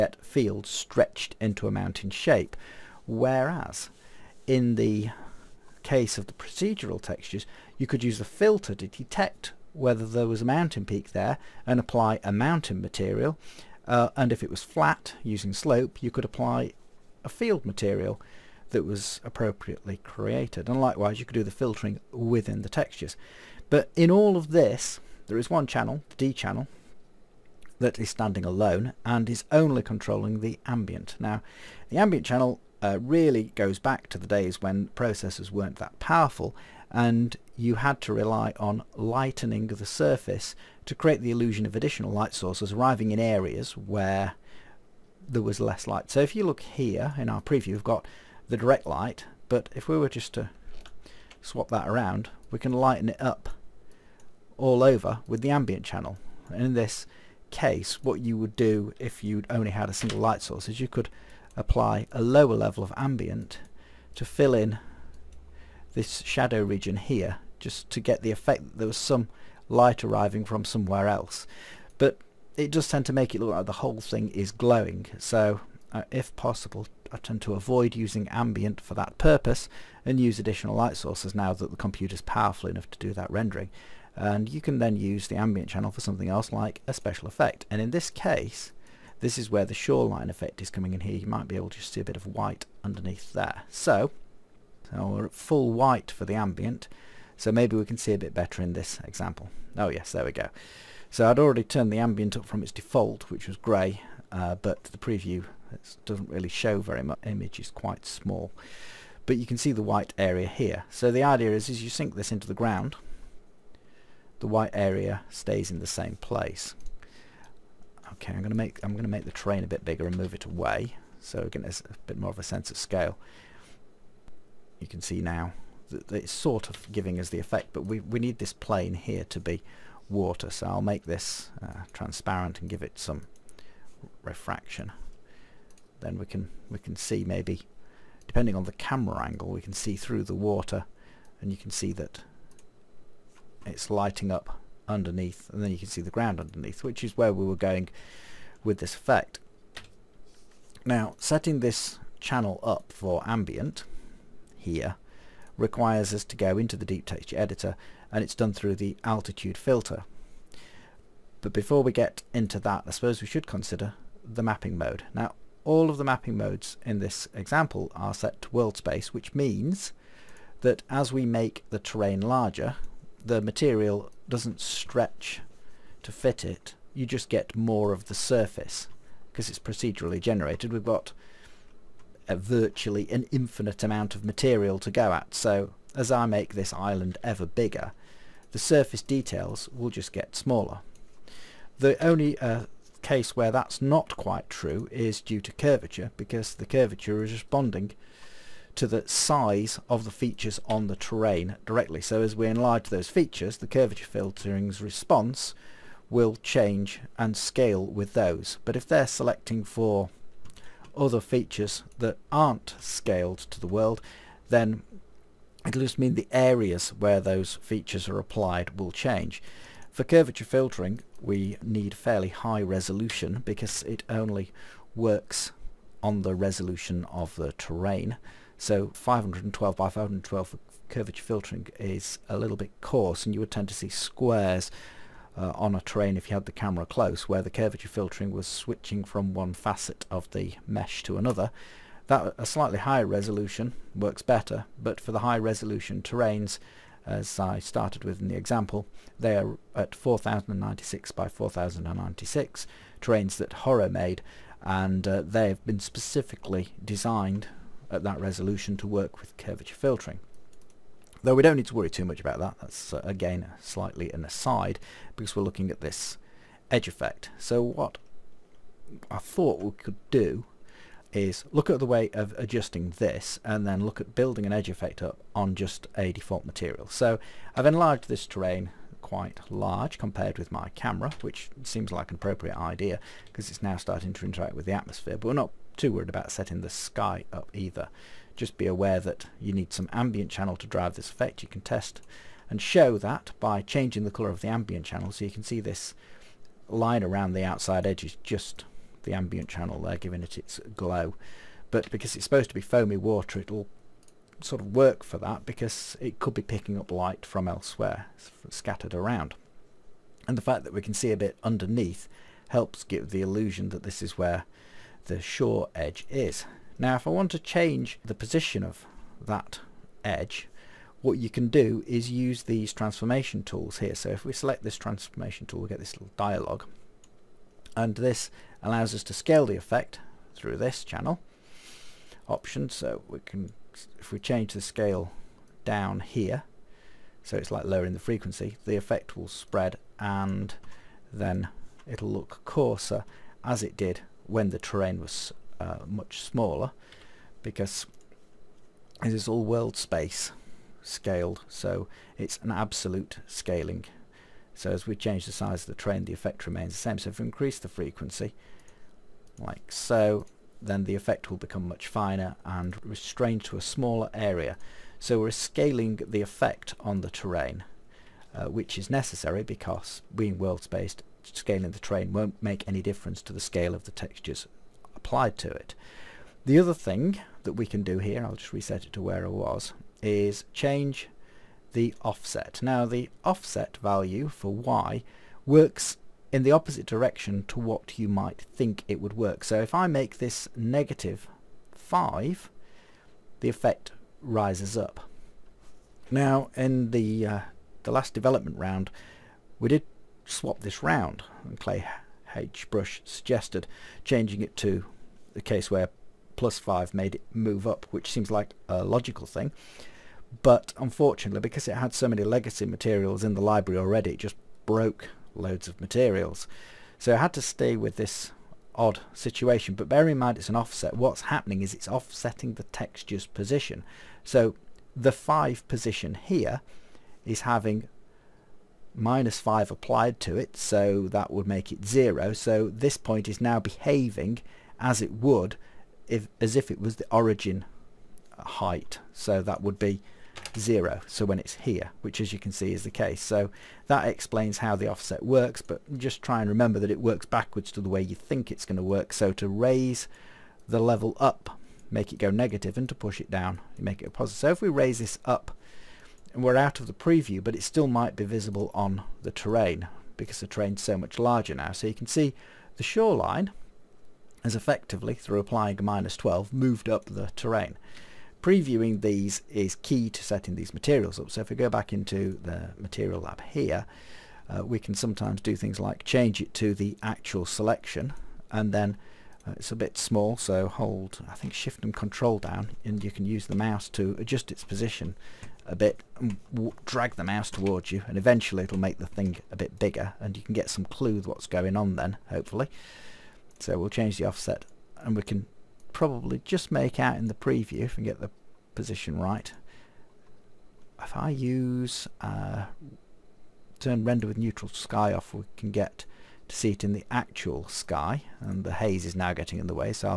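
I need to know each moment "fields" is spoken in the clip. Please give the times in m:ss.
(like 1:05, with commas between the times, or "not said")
0:00, 0:17.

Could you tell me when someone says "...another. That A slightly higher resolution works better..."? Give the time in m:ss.
4:01.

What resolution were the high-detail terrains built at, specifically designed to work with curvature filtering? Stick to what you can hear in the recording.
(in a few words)
4096 by 4096.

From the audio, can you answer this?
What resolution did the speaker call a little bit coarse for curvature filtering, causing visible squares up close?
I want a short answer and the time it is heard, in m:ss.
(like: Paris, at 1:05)
512 by 512, at 3:48.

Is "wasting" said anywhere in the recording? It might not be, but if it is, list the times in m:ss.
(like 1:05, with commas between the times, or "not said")
not said.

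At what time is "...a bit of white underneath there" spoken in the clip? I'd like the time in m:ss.
1:31.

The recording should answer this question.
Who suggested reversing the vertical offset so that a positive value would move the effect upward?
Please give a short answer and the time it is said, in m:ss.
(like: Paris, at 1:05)
Clay H. Brush, at 6:41.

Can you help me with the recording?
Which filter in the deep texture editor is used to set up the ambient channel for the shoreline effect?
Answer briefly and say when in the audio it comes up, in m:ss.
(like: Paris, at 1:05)
altitude filter, at 2:39.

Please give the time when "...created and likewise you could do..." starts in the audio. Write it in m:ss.
0:19.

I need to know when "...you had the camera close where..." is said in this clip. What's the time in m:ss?
3:56.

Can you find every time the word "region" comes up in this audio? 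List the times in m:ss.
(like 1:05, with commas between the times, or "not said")
1:06.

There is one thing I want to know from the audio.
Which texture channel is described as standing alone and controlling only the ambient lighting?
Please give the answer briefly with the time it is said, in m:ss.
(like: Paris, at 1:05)
D channel, at 0:26.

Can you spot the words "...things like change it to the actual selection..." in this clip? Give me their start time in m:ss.
7:55.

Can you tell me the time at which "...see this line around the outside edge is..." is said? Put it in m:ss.
4:55.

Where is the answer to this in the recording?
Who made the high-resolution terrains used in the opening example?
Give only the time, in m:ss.
4:13.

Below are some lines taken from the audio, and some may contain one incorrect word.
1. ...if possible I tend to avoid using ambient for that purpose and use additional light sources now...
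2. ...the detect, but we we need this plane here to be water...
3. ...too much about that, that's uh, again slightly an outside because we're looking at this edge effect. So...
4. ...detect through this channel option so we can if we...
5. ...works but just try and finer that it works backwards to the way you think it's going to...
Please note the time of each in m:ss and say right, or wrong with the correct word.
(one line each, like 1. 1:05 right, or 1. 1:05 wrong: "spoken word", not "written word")
1. 1:16 right
2. 2:07 wrong: "effect", not "detect"
3. 4:21 wrong: "aside", not "outside"
4. 5:29 wrong: "effect", not "detect"
5. 7:25 wrong: "remember", not "finer".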